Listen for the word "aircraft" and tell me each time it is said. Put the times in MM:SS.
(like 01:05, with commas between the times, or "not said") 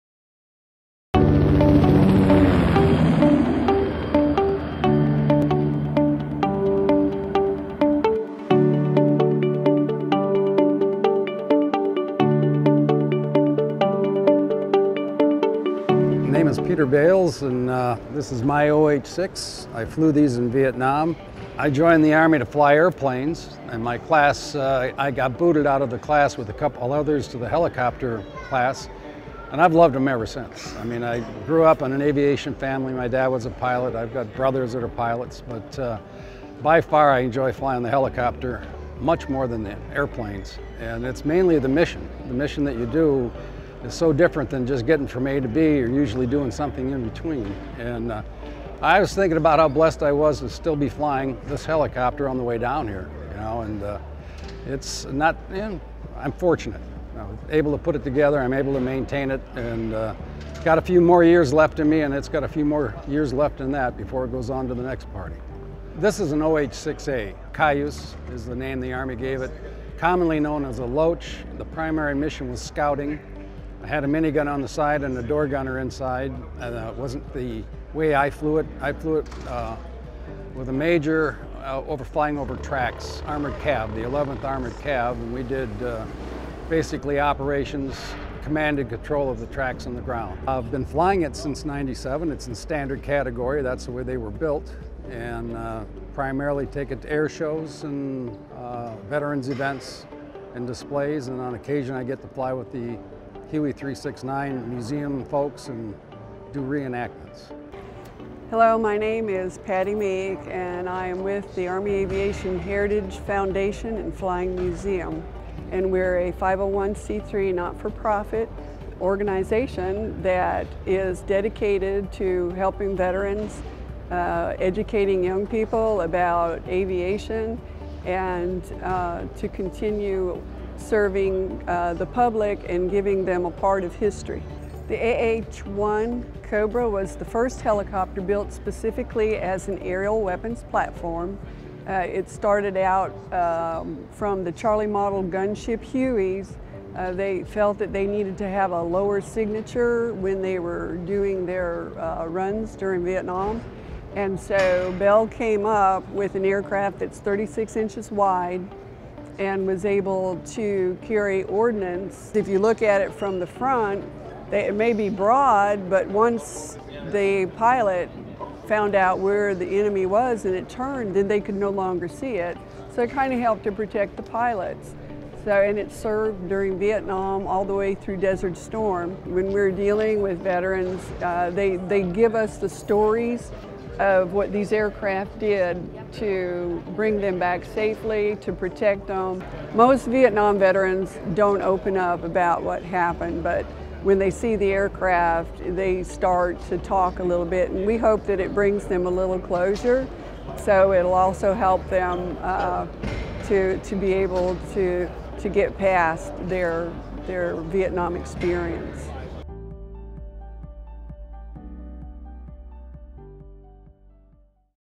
02:36, 03:04, 03:14.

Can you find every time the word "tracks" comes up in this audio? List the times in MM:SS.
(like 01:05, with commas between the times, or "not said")
01:22, 01:29.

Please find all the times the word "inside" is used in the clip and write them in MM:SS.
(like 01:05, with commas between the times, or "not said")
01:15.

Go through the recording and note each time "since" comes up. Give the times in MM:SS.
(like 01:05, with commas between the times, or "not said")
00:30, 01:31.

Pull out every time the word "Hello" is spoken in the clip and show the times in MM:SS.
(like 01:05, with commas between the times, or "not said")
01:48.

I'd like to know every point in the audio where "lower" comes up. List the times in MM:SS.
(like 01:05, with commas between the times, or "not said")
02:28.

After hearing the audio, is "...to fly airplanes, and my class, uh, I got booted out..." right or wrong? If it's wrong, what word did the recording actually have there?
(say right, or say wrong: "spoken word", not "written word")
right.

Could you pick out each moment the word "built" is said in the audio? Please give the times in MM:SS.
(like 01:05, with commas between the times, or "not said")
01:34, 02:18.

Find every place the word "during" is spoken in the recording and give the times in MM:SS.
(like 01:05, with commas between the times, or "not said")
02:32, 02:56.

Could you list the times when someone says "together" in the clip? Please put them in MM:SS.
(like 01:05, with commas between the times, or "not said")
00:58.